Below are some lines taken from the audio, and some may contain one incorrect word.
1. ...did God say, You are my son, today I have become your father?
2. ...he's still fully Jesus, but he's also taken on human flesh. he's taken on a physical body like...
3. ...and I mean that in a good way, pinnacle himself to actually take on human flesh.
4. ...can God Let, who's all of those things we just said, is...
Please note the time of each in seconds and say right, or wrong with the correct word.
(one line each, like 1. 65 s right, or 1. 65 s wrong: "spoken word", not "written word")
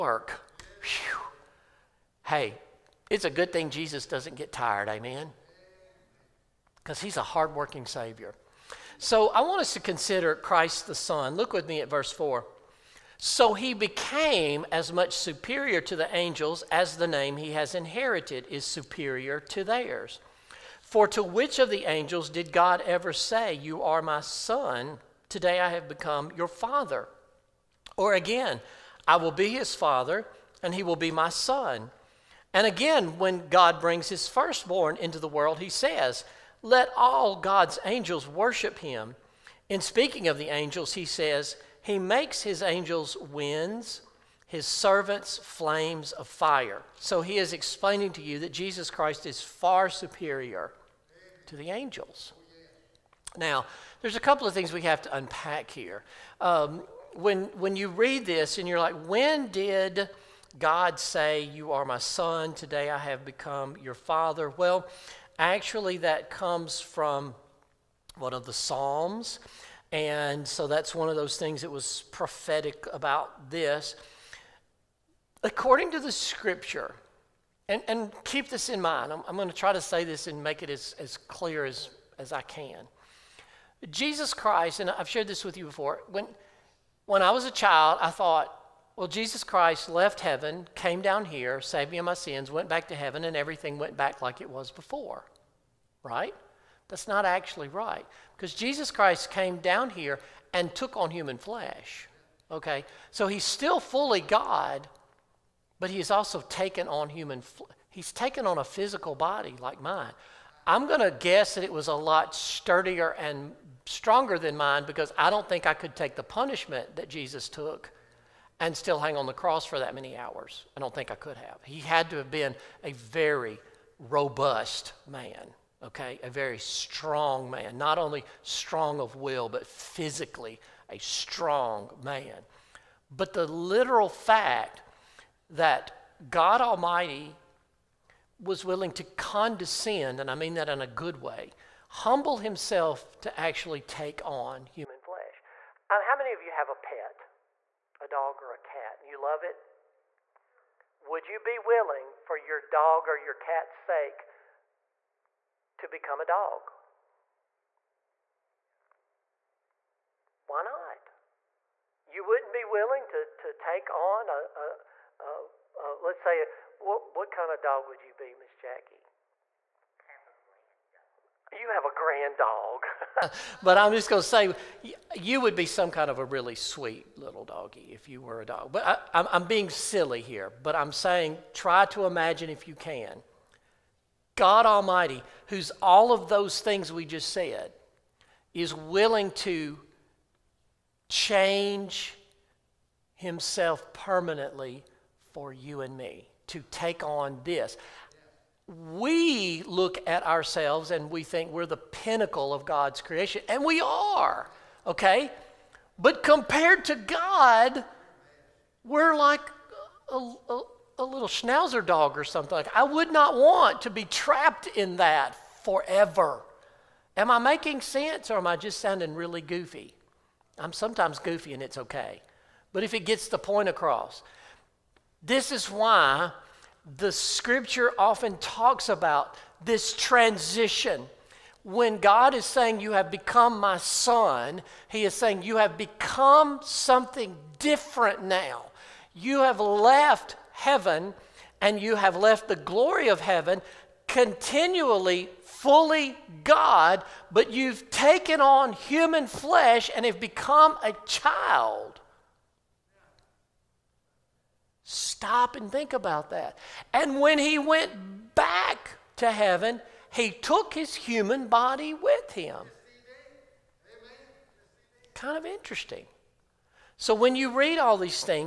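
1. 59 s right
2. 103 s wrong: "God", not "Jesus"
3. 140 s wrong: "humble", not "pinnacle"
4. 182 s wrong: "Almighty", not "Let".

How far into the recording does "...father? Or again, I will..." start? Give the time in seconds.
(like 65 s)
26 s.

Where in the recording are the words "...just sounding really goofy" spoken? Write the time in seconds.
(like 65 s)
218 s.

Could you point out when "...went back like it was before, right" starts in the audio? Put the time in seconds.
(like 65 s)
93 s.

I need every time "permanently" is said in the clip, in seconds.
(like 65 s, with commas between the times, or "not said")
193 s.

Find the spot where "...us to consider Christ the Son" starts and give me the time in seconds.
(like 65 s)
9 s.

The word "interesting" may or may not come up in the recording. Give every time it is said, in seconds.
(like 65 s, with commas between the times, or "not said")
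265 s.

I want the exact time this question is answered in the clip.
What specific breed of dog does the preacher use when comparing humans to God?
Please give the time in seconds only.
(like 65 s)
211 s.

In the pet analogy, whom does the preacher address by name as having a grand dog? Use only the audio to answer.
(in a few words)
Miss Jackie.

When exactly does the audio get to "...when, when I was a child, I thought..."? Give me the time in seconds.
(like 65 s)
86 s.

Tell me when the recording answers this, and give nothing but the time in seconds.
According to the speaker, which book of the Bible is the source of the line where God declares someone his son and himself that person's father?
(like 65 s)
68 s.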